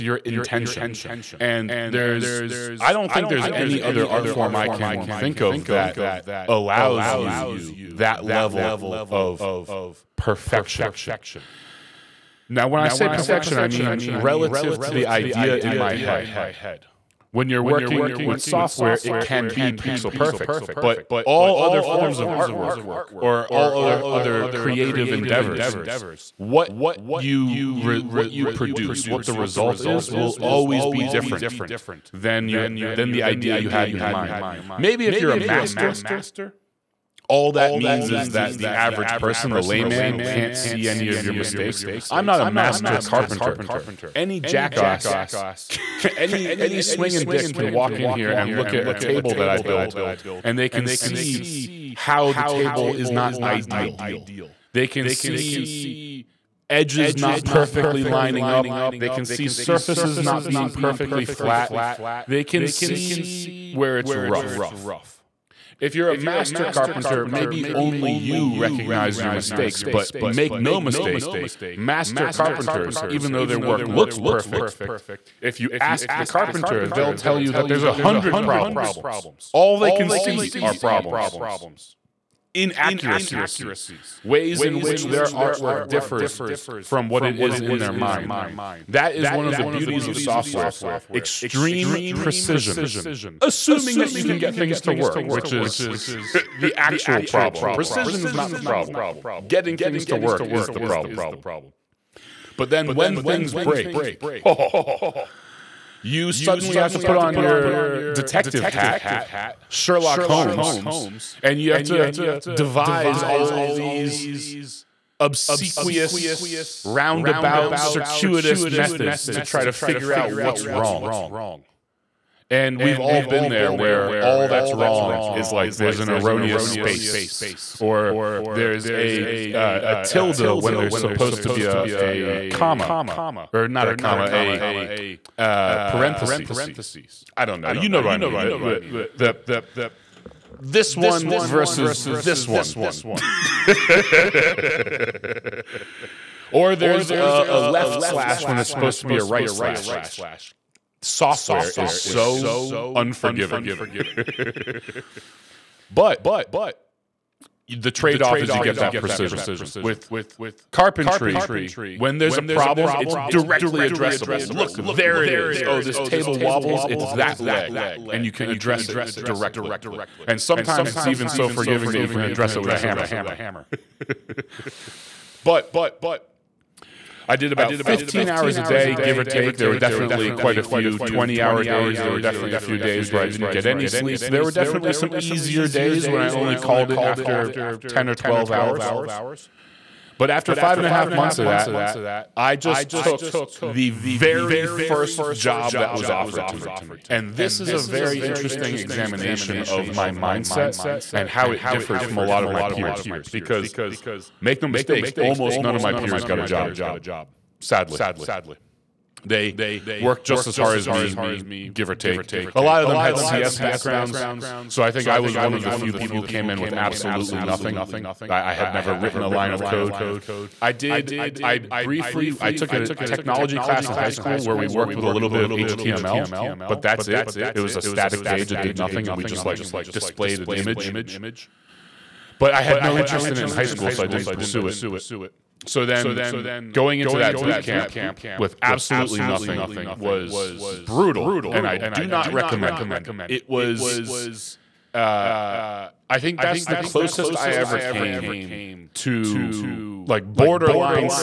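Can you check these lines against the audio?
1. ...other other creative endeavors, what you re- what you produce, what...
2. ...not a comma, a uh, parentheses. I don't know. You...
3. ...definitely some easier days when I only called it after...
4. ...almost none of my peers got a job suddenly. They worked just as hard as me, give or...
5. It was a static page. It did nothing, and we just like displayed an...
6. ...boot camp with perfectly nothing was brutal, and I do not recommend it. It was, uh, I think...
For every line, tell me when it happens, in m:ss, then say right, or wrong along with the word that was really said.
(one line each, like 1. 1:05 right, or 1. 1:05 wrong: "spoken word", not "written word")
1. 0:23 right
2. 2:13 right
3. 3:04 right
4. 3:25 wrong: "sadly", not "suddenly"
5. 3:47 right
6. 3:57 wrong: "absolutely", not "perfectly".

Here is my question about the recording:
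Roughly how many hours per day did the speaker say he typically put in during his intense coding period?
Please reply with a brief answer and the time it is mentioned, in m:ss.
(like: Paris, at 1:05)
15, at 2:57.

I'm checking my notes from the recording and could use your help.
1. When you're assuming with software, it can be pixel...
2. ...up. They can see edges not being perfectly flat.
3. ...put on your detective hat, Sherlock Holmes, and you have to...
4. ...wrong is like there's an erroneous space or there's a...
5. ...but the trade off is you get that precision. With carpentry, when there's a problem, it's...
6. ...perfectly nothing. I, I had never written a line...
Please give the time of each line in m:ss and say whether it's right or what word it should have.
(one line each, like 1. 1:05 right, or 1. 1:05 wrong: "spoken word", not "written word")
1. 0:17 wrong: "working", not "assuming"
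2. 0:58 wrong: "surfaces", not "edges"
3. 1:46 right
4. 2:04 right
5. 2:35 right
6. 3:36 wrong: "absolutely", not "perfectly".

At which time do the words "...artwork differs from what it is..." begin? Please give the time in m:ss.
1:25.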